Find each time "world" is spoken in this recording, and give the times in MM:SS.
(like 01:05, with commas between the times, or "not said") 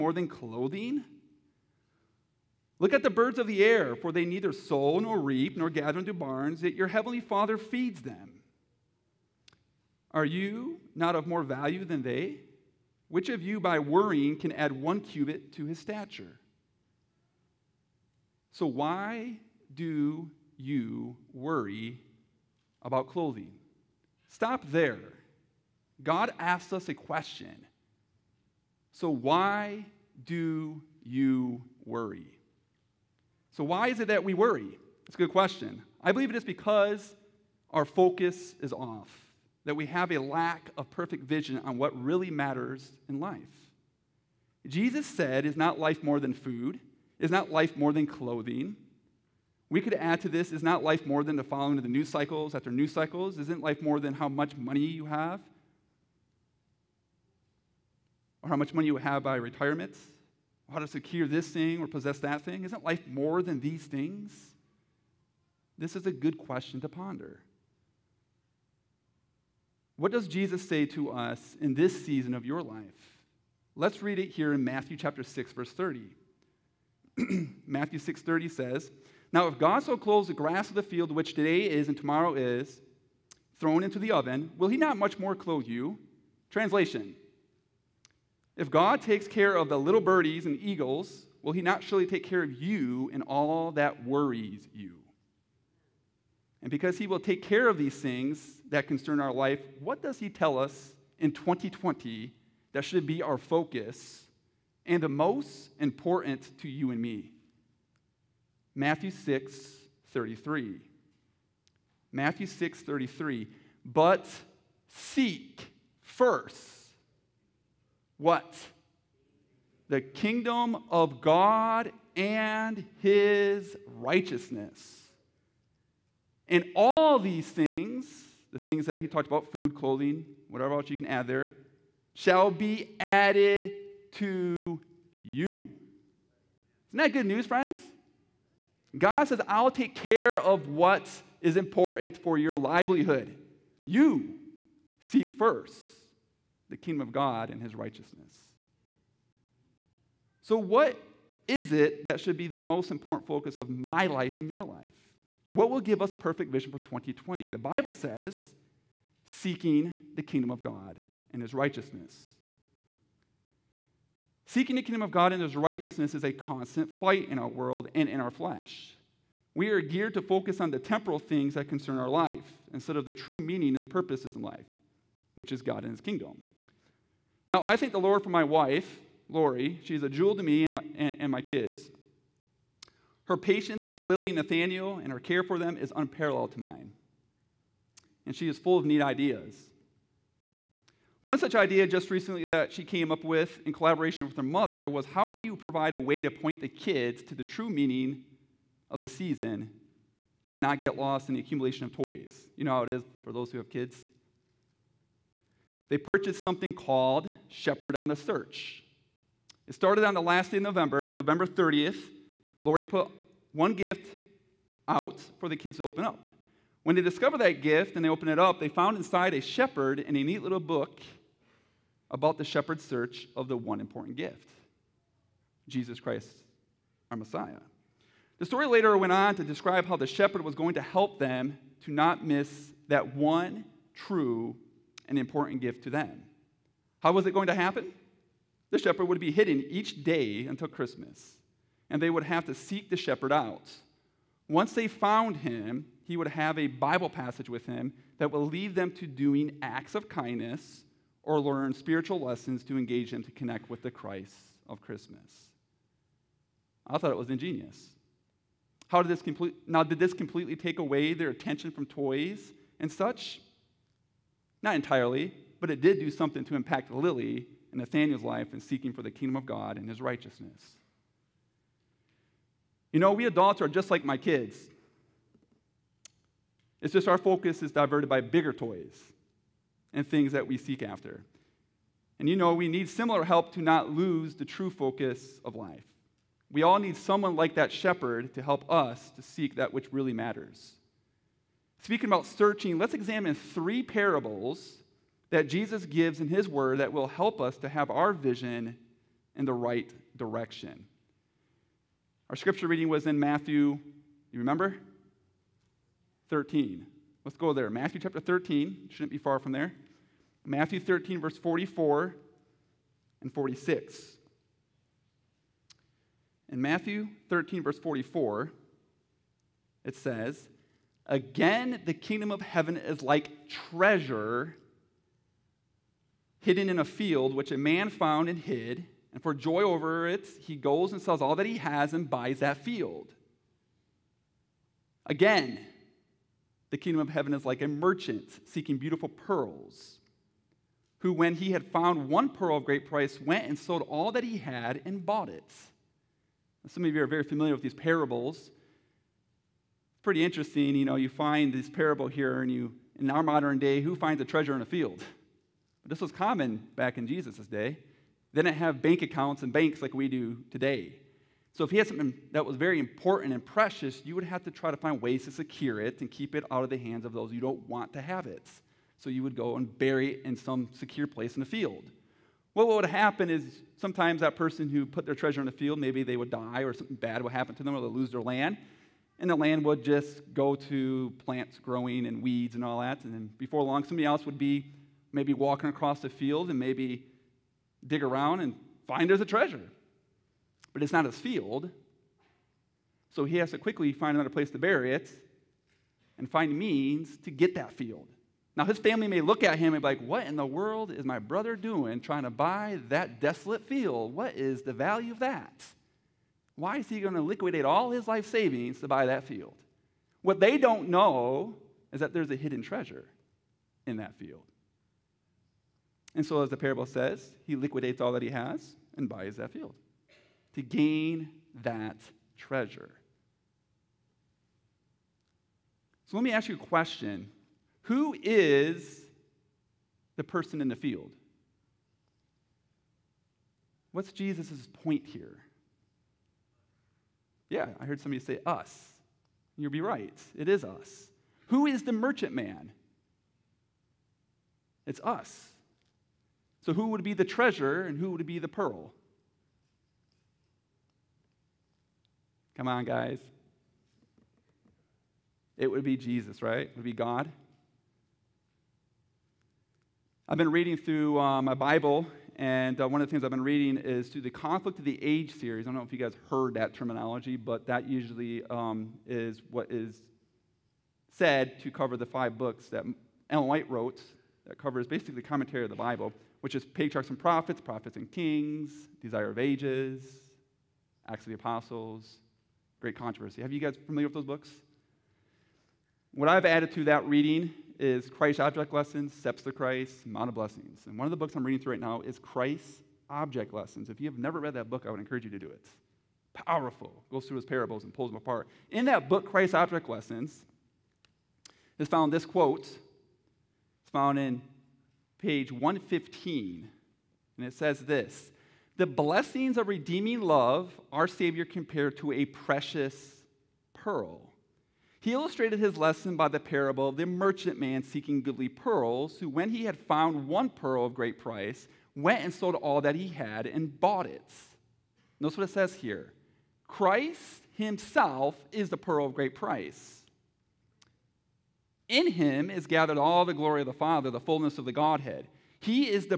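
02:47, 06:40.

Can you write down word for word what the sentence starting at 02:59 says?
She's a jewel to me and my, and, and my kids.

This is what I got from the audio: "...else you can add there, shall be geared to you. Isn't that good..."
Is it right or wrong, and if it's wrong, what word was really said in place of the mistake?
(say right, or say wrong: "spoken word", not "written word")
wrong: "added", not "geared".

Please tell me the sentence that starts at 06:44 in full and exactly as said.
What is the value of that?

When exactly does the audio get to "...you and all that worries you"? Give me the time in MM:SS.
01:32.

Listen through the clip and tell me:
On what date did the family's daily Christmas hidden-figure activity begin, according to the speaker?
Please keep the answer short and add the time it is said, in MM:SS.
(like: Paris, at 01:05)
November 30th, at 03:31.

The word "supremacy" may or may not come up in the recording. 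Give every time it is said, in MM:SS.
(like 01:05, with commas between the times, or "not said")
not said.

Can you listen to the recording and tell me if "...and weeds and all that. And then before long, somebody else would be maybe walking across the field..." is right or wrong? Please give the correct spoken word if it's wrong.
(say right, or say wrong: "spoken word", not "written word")
right.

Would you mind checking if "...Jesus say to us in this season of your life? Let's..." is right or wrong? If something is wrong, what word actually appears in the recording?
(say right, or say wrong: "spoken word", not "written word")
right.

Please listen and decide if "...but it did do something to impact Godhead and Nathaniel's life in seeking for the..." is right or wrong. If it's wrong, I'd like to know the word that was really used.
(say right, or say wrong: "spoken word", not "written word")
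wrong: "Lily", not "Godhead".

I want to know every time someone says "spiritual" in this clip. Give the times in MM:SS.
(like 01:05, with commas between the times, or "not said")
04:11.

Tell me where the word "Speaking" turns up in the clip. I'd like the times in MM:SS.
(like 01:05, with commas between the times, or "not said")
04:51.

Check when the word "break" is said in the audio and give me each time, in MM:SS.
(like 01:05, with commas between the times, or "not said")
not said.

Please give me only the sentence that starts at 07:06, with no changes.
So, let me ask you a question Who is the person in the field?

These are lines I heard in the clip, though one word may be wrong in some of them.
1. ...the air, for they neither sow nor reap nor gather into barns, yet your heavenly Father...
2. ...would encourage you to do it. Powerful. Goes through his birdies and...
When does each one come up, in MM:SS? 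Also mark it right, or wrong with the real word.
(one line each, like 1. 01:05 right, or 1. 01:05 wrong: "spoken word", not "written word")
1. 00:03 right
2. 08:14 wrong: "parables", not "birdies".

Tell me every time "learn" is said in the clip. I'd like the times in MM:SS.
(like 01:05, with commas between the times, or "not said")
04:11.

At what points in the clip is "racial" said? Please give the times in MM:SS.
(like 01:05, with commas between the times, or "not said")
not said.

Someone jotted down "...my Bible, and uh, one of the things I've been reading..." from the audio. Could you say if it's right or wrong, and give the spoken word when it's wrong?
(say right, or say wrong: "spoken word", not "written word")
right.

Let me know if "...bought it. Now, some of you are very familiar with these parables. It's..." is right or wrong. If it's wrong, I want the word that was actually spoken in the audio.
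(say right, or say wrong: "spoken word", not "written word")
right.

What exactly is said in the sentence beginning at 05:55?
this was common back in Jesus' day.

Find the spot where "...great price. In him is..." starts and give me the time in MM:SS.
08:49.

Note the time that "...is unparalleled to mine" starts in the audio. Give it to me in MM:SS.
03:05.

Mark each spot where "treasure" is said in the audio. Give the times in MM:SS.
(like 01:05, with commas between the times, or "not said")
05:23, 05:54, 06:15, 06:29, 06:52, 07:02, 07:27.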